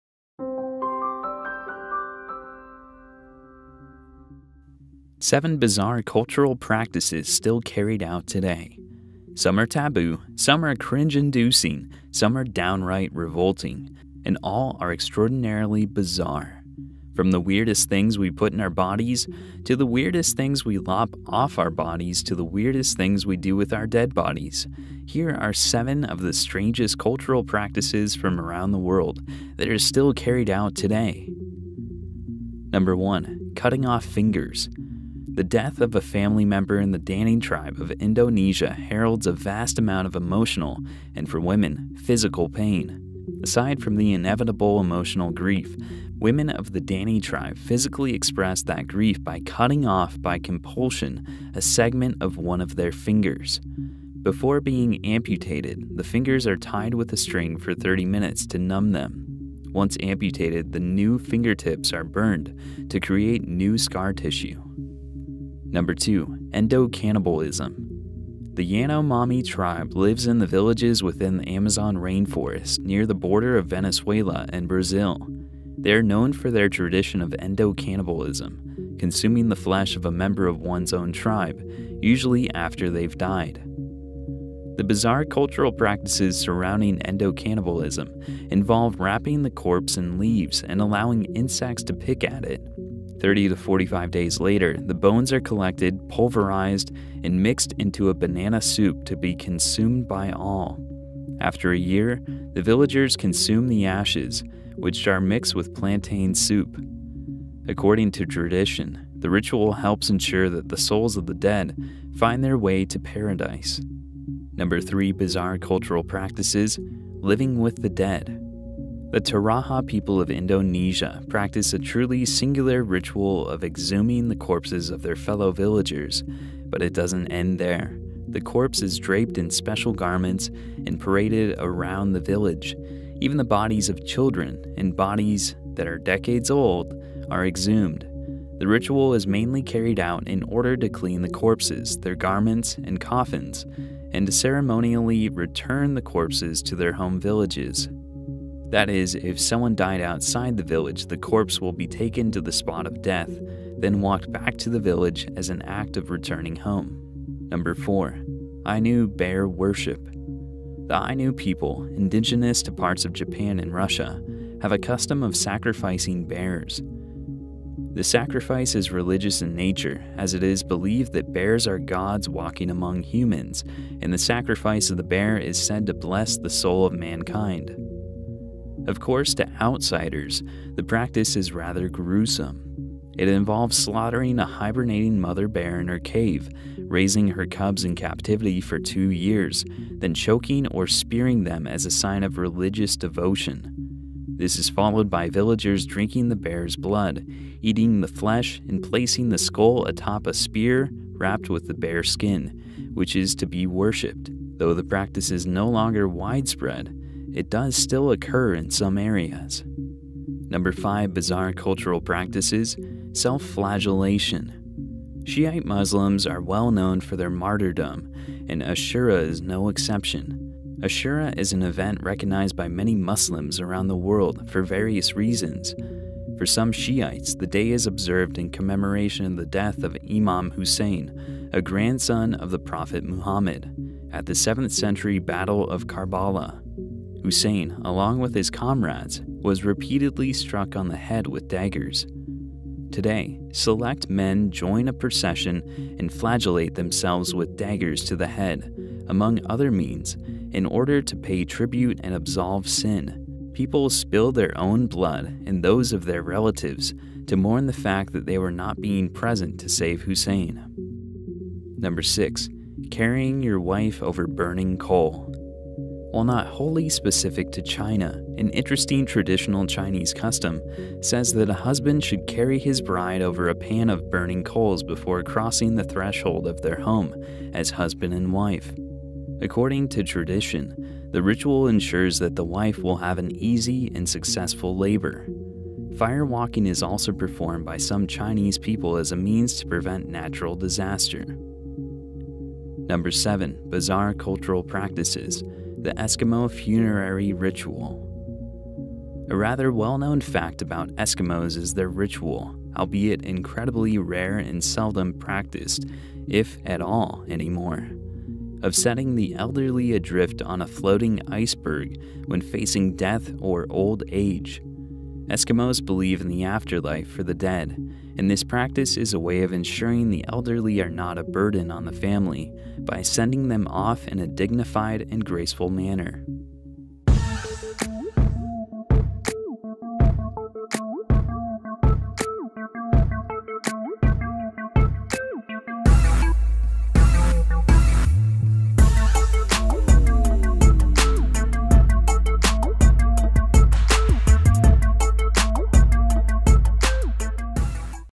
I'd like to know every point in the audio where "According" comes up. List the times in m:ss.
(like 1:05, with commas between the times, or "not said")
1:47, 4:39.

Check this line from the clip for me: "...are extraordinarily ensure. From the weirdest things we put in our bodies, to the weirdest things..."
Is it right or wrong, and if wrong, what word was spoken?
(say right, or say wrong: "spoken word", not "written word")
wrong: "bizarre", not "ensure".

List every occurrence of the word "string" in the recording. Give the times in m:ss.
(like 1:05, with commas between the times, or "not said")
0:57.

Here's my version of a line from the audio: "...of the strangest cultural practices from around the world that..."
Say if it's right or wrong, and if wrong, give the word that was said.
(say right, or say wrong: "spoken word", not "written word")
right.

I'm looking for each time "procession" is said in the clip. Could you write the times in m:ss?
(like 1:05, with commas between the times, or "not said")
4:04.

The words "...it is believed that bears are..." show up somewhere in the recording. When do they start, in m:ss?
2:50.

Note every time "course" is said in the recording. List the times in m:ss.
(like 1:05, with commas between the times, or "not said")
2:58.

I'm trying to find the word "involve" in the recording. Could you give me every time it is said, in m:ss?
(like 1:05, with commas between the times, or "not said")
1:28, 3:03.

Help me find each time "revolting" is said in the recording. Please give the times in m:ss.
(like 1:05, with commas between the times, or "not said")
0:13.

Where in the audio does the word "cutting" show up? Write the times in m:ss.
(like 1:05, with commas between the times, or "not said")
0:33, 0:49.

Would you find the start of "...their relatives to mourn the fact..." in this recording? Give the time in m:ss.
4:16.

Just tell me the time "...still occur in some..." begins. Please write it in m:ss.
3:27.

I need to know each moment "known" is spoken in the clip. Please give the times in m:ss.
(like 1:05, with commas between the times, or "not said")
1:16, 3:36, 4:59.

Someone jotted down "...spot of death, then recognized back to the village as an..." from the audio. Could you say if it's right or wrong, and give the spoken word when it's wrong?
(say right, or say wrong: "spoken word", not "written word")
wrong: "walked", not "recognized".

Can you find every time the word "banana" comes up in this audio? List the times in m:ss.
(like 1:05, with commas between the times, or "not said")
1:38.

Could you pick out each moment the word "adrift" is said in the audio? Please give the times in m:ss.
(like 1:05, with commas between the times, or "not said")
5:09.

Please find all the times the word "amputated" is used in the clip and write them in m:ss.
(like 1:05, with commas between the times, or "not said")
0:55, 1:00.